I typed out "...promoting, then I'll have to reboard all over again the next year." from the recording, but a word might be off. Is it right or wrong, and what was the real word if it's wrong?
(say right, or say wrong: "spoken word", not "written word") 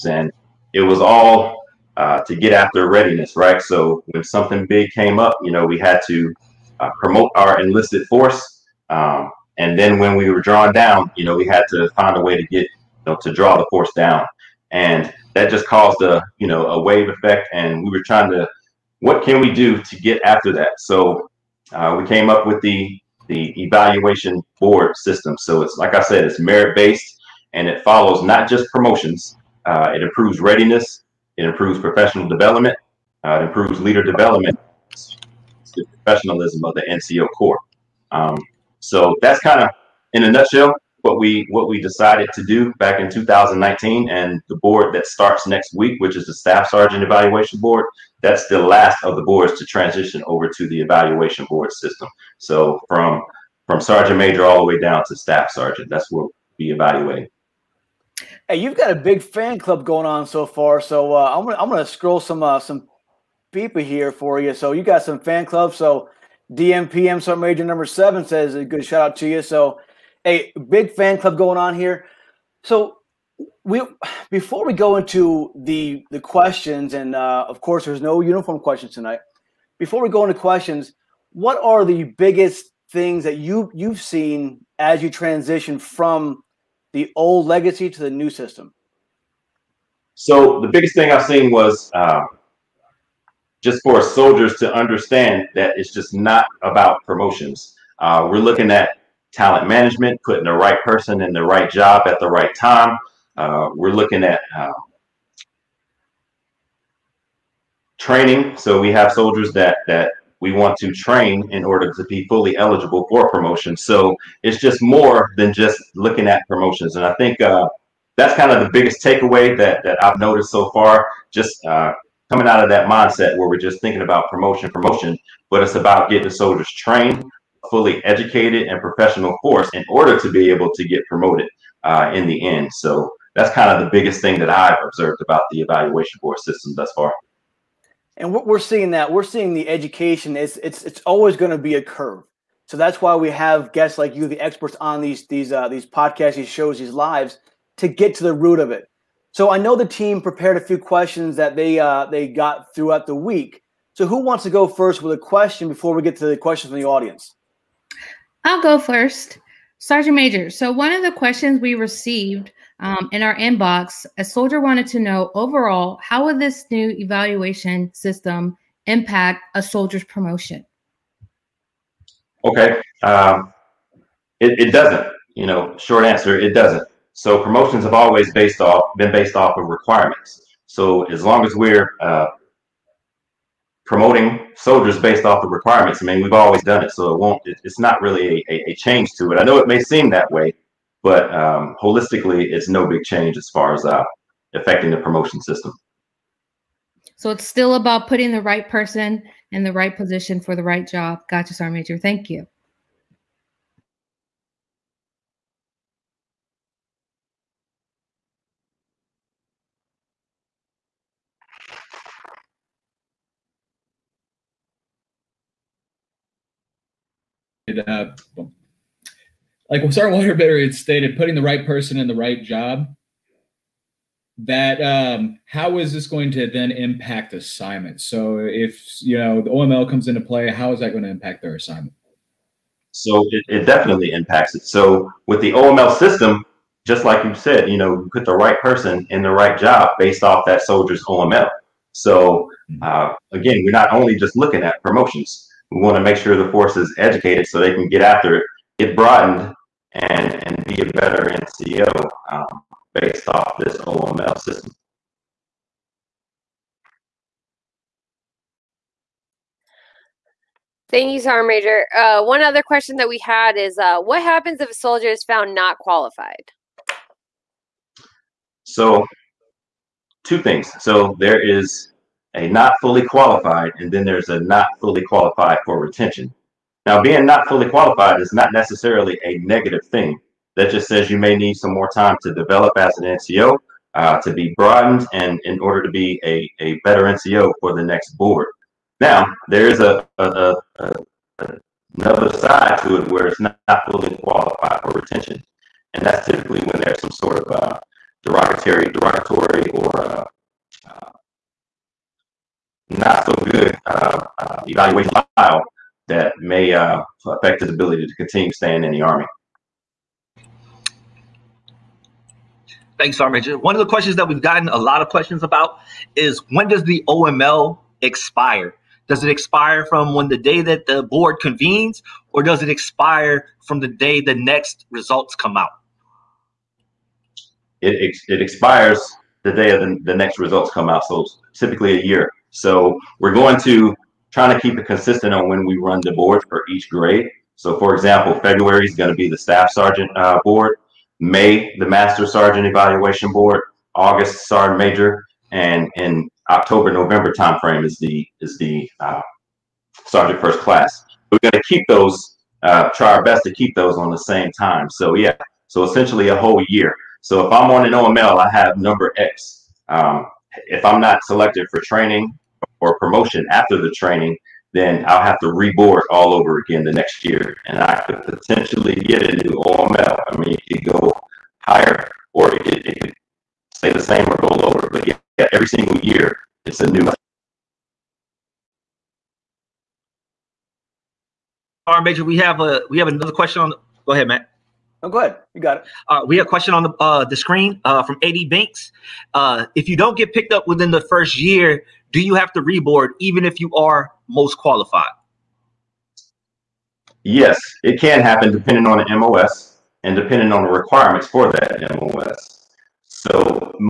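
wrong: "training", not "promoting".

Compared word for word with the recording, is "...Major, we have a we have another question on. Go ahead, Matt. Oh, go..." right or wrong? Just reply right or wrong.
right.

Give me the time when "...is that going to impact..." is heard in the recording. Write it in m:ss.
3:50.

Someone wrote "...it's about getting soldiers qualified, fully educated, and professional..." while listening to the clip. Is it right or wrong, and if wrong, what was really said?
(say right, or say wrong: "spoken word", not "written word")
wrong: "trained", not "qualified".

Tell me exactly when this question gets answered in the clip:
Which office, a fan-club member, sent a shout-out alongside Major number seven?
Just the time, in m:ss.
1:06.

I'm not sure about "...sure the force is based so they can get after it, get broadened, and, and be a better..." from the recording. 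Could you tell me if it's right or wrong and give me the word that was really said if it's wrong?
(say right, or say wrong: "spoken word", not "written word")
wrong: "educated", not "based".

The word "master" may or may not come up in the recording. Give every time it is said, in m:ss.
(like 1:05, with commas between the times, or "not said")
5:41.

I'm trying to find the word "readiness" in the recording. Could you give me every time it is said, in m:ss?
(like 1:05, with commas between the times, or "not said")
0:02, 0:30.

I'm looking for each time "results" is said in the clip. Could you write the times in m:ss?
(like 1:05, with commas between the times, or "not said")
5:24, 5:30.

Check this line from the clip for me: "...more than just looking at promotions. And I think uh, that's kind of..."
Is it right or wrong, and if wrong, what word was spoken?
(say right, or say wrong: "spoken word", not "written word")
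right.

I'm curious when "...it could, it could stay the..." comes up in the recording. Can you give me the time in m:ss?
6:12.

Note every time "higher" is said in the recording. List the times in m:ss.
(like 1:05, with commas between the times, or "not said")
6:11.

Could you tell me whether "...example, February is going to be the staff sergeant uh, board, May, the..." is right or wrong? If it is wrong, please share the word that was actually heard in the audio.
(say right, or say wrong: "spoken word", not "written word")
right.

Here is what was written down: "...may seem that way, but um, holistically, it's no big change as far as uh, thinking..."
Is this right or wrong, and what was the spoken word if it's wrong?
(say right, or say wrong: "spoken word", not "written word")
wrong: "affecting", not "thinking".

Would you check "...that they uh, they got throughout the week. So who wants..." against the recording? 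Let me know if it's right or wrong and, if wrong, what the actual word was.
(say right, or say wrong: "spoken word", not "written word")
right.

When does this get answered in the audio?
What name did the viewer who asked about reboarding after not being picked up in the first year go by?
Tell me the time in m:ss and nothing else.
6:28.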